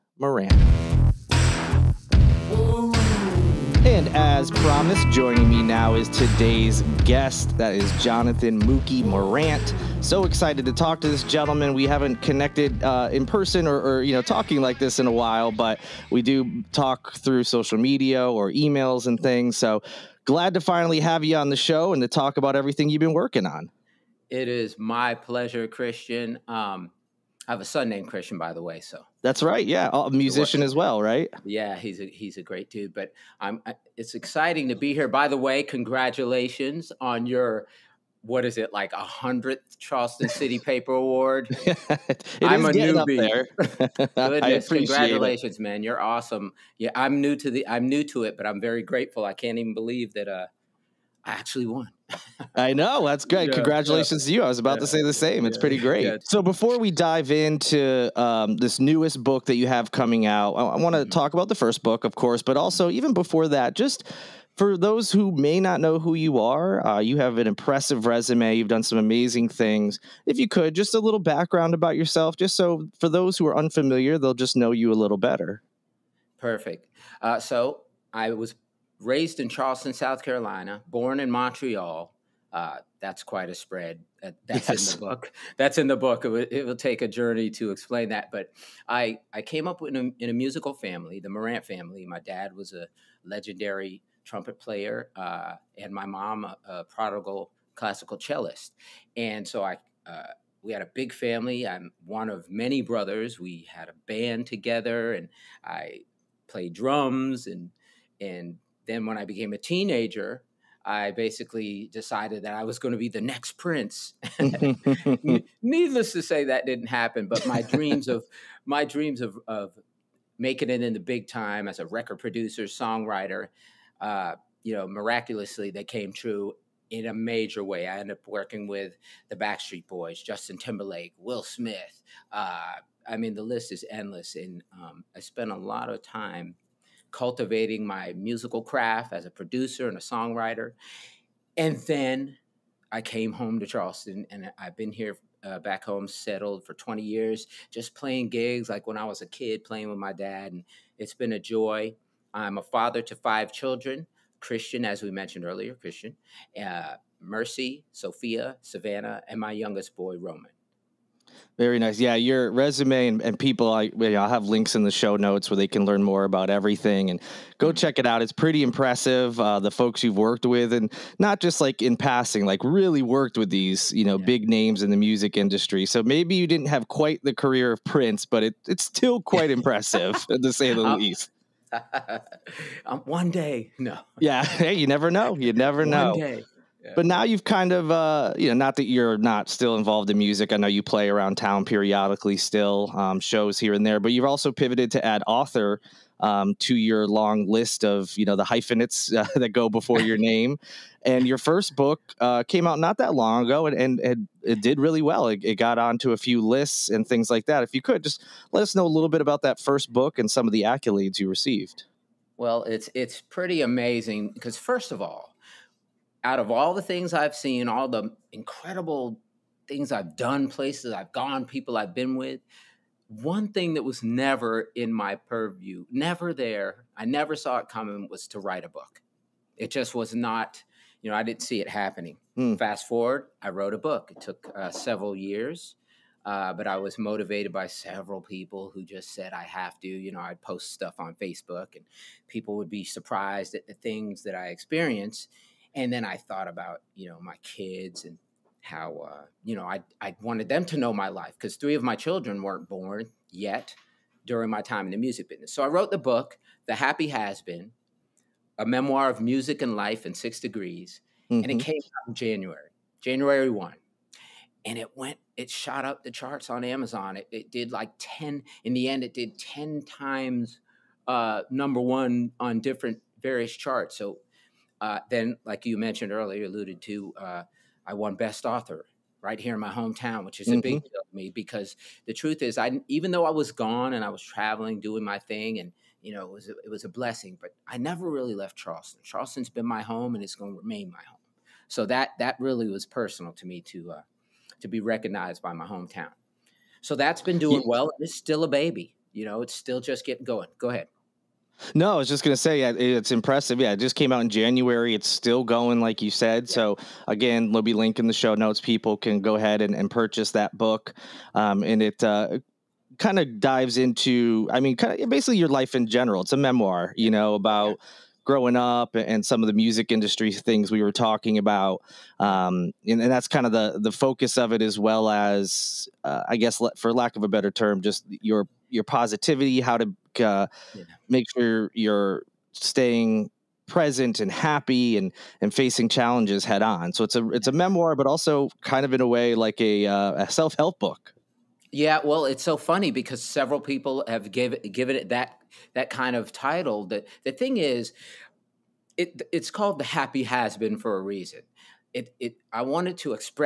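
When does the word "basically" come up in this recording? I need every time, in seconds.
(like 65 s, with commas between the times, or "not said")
111 s, 315 s.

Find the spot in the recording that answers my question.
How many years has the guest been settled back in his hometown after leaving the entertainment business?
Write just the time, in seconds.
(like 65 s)
146 s.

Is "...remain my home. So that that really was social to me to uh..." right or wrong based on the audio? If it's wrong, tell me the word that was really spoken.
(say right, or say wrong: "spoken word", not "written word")
wrong: "personal", not "social".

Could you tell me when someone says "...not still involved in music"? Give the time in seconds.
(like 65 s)
189 s.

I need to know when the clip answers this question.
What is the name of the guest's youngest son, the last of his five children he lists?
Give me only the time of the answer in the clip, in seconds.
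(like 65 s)
160 s.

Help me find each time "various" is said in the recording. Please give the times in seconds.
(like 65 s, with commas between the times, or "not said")
273 s.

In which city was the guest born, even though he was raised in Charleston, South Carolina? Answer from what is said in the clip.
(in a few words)
Montreal.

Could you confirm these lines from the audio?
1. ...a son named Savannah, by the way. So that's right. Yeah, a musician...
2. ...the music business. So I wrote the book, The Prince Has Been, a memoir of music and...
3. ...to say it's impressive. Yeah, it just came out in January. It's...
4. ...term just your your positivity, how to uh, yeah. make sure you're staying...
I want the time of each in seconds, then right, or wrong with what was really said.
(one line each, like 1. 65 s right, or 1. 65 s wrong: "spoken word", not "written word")
1. 27 s wrong: "Christian", not "Savannah"
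2. 254 s wrong: "Happy", not "Prince"
3. 302 s right
4. 327 s right.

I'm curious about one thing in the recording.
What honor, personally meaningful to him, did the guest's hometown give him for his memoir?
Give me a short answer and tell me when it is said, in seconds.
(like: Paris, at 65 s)
Best Author, at 278 s.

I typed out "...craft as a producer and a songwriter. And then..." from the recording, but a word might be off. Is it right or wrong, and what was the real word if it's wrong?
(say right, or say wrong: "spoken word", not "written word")
right.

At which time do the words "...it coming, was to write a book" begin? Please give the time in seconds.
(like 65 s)
227 s.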